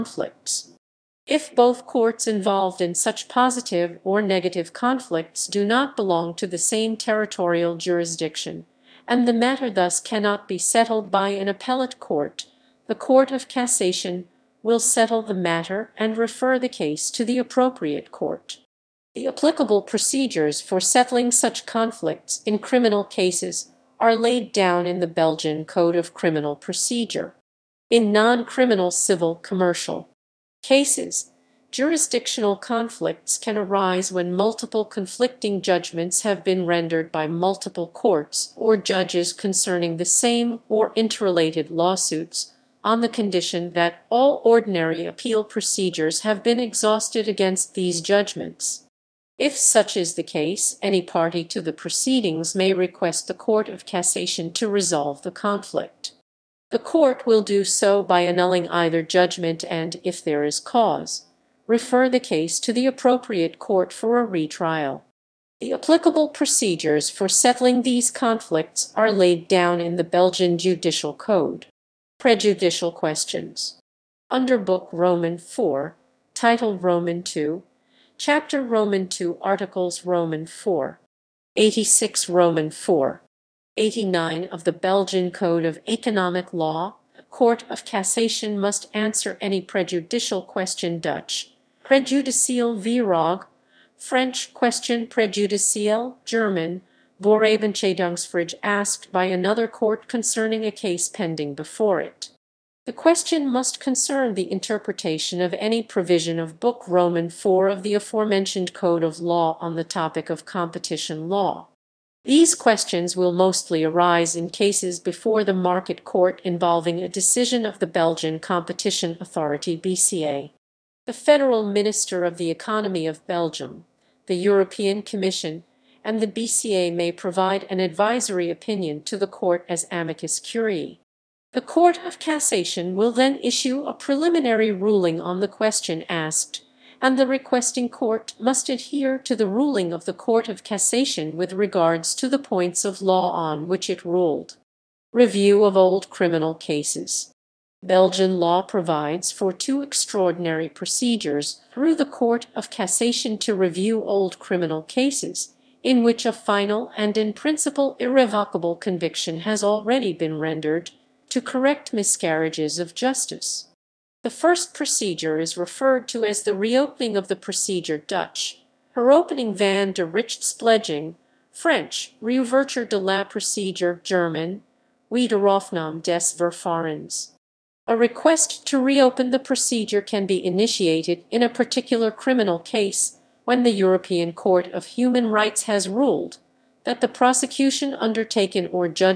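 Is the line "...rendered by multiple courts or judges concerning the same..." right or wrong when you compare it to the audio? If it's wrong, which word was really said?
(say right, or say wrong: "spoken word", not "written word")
right.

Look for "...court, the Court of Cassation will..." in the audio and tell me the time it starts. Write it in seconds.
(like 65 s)
11 s.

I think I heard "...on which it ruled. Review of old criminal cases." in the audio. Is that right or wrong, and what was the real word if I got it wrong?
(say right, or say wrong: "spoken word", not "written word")
right.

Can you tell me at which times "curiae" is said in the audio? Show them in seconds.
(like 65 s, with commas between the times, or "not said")
130 s.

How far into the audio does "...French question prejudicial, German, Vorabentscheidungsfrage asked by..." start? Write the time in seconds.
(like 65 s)
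93 s.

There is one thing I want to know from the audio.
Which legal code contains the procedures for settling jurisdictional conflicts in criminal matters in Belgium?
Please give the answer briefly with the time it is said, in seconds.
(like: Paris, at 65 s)
Belgian Code of Criminal Procedure, at 25 s.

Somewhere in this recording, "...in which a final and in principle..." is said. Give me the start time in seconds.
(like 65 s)
155 s.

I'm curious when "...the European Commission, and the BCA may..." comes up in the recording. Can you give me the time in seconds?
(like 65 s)
124 s.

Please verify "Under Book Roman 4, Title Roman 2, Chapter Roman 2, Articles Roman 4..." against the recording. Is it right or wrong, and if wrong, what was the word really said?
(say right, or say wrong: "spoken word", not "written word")
right.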